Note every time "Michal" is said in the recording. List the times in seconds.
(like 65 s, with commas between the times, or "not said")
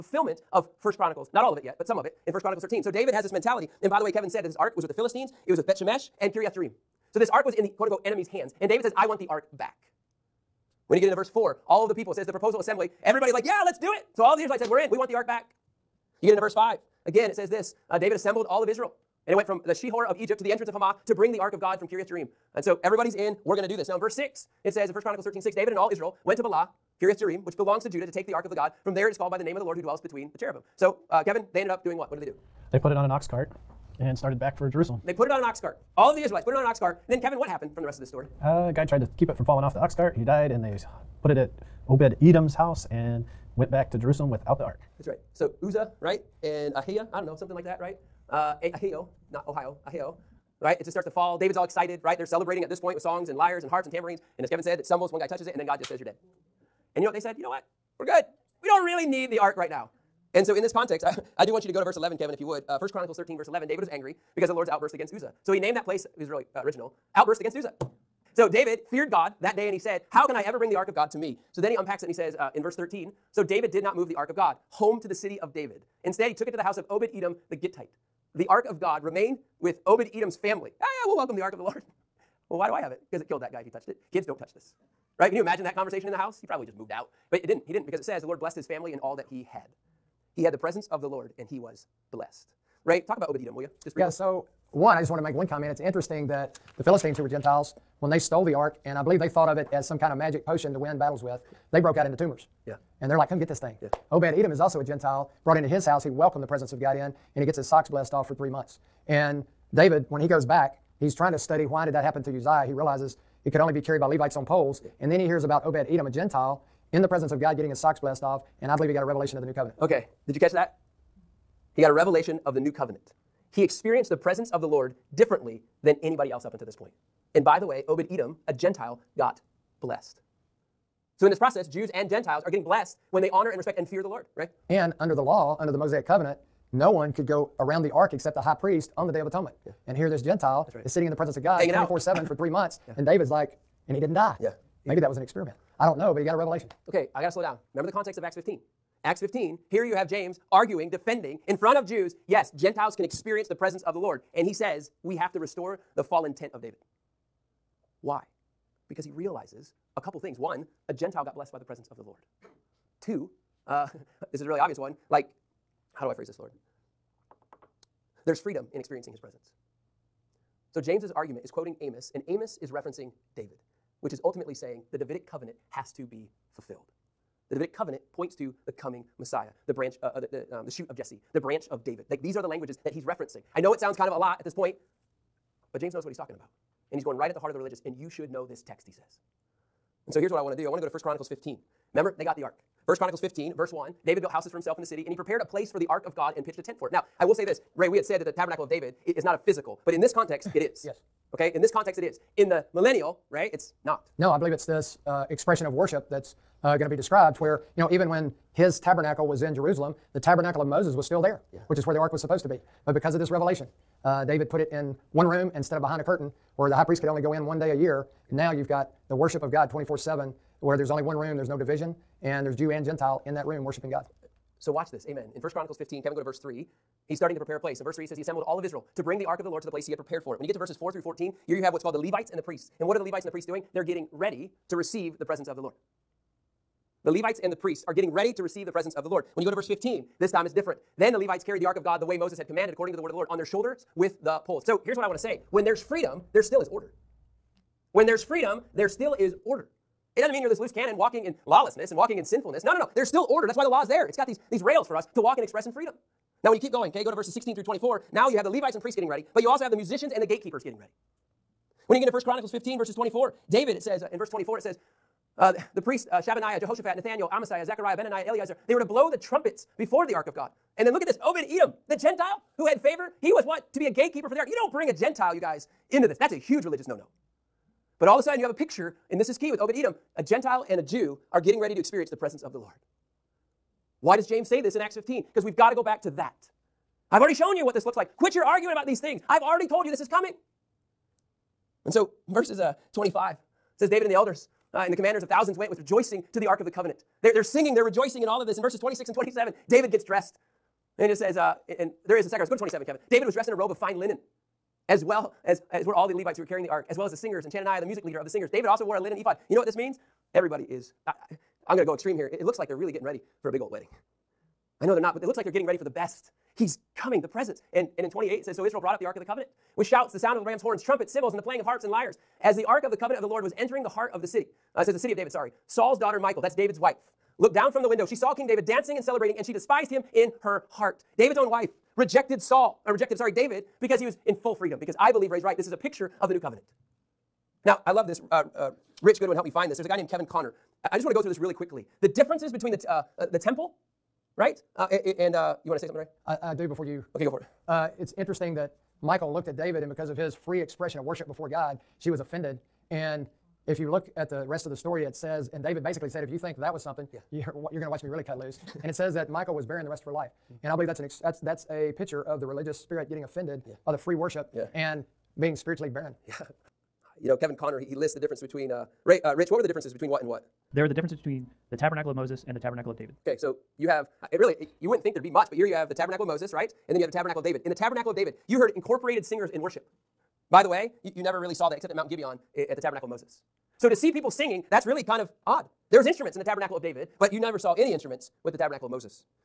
326 s, 349 s, 359 s.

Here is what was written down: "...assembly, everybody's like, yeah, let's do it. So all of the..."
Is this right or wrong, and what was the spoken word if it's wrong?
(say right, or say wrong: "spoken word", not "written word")
right.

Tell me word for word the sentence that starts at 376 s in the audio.
And then you have the tabernacle of David.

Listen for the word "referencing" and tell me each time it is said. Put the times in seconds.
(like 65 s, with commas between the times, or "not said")
172 s, 183 s.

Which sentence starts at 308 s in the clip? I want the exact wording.
David also wore a linen ephod.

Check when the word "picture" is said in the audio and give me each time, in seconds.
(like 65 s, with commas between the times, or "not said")
278 s, 335 s, 361 s.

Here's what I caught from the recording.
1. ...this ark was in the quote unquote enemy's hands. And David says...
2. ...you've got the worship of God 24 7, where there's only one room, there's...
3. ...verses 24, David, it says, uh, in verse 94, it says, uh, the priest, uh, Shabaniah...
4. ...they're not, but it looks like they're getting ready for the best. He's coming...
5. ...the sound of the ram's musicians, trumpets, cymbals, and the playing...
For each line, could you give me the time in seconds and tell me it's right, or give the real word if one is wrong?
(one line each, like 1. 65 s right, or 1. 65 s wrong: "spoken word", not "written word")
1. 7 s right
2. 218 s right
3. 262 s wrong: "24", not "94"
4. 314 s right
5. 320 s wrong: "horns", not "musicians".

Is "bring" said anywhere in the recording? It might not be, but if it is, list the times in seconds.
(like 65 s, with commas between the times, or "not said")
21 s, 70 s, 229 s, 274 s.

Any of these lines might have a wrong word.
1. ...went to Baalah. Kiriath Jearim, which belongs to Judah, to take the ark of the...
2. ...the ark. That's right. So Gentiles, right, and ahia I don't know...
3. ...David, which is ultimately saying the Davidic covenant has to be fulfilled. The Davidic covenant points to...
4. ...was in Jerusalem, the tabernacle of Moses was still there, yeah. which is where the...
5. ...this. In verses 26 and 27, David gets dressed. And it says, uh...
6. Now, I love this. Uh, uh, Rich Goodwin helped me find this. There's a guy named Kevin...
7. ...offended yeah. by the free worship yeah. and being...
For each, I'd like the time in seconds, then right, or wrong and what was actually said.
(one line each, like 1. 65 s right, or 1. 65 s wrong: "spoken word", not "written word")
1. 26 s right
2. 44 s wrong: "Uzzah", not "Gentiles"
3. 173 s right
4. 209 s right
5. 298 s right
6. 337 s right
7. 363 s right.